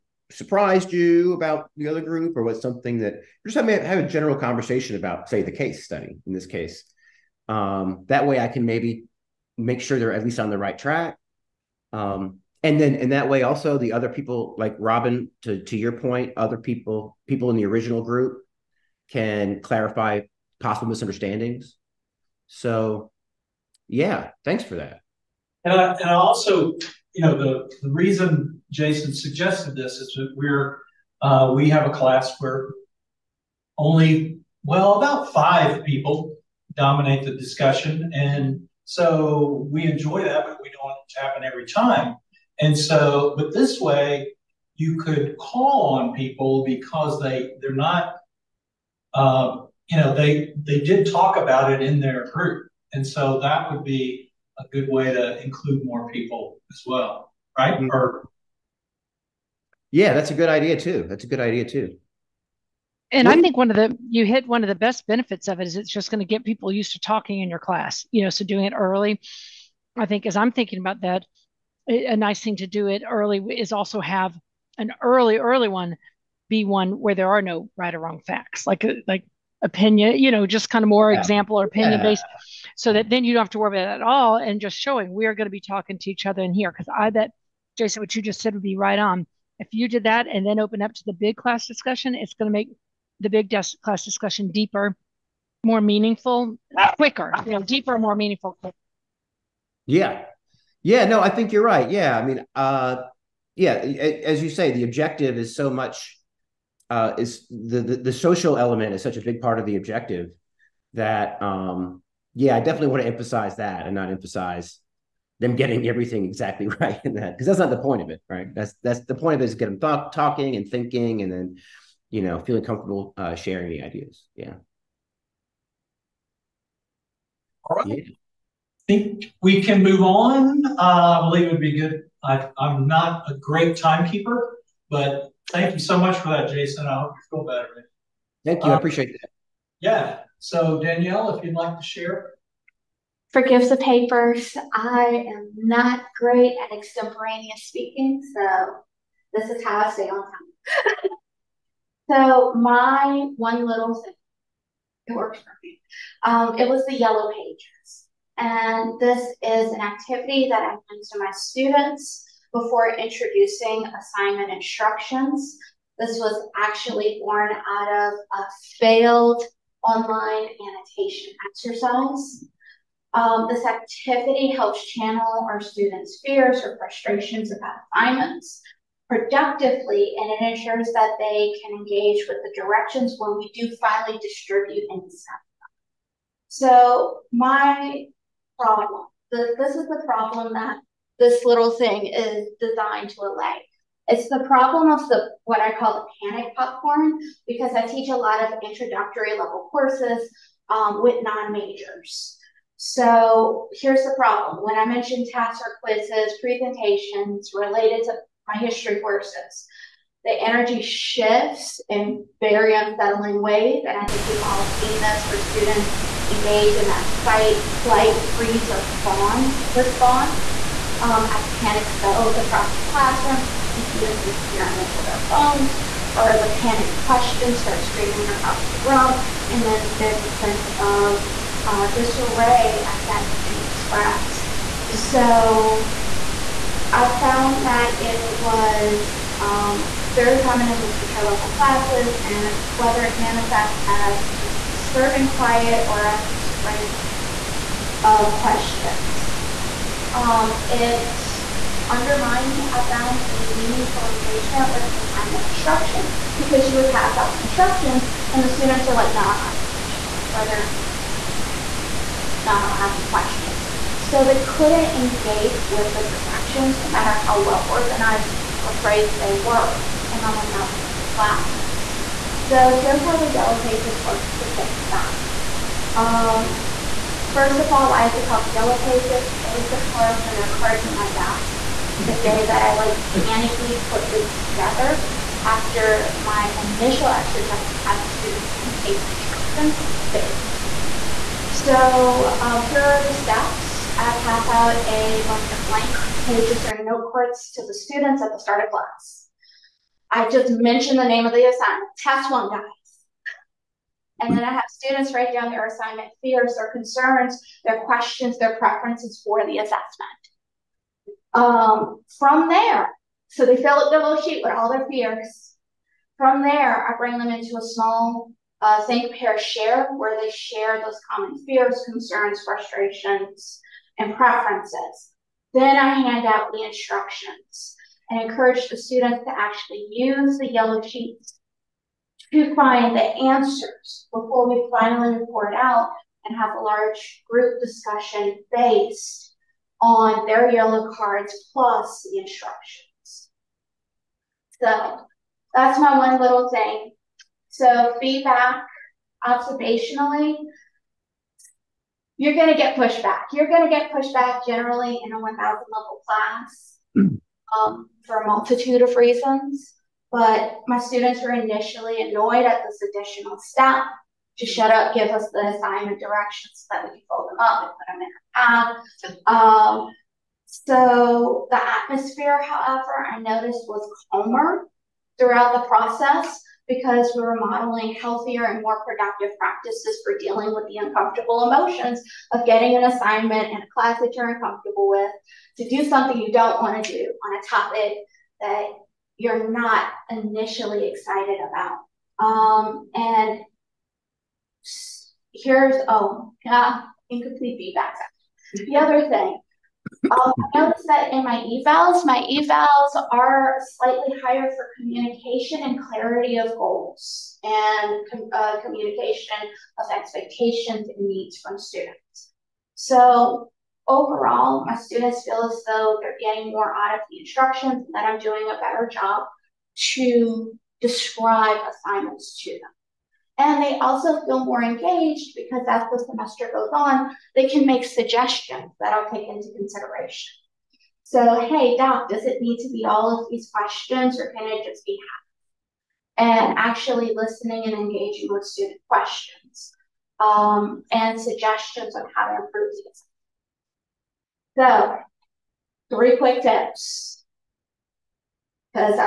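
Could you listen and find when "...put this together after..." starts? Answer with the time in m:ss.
4:43.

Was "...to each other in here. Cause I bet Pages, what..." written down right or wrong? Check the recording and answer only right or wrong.
wrong.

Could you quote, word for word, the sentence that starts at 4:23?
So they couldn't engage with the directions no matter how well organized or phrased they were in my 1,000 level classes.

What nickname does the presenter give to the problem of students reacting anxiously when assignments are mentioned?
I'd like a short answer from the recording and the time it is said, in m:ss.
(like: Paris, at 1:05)
Panic popcorn, at 3:16.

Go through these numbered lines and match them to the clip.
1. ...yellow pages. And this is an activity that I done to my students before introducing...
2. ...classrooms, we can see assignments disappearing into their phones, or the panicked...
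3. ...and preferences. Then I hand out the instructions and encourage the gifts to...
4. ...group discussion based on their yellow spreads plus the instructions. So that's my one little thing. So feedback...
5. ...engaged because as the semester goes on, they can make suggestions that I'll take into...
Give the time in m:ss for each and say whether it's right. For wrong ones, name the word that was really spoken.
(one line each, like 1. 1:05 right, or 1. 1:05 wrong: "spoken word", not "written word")
1. 2:36 right
2. 3:42 wrong: "students", not "assignments"
3. 5:23 wrong: "students", not "gifts"
4. 5:37 wrong: "cards", not "spreads"
5. 7:04 right.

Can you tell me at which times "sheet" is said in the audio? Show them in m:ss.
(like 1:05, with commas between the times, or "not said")
5:14, 5:30.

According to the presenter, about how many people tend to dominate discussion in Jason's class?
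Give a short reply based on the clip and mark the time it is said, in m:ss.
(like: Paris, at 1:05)
5, at 0:35.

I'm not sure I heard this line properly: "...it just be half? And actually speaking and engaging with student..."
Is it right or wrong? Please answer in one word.
wrong.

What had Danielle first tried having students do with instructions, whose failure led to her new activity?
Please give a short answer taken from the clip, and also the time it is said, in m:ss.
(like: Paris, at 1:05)
Online annotation exercise, at 2:49.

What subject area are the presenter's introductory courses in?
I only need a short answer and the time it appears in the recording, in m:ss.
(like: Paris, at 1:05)
History, at 3:28.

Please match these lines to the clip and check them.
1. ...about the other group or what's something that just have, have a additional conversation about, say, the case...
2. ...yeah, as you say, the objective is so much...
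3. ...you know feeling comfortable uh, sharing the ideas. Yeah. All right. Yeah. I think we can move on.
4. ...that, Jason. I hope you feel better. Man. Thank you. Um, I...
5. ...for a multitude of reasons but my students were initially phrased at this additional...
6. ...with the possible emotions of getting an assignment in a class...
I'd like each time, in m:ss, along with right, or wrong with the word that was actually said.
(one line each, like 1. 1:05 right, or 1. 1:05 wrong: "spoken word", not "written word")
1. 0:01 wrong: "general", not "additional"
2. 1:43 right
3. 2:02 right
4. 2:16 right
5. 5:58 wrong: "annoyed", not "phrased"
6. 6:20 wrong: "uncomfortable", not "possible".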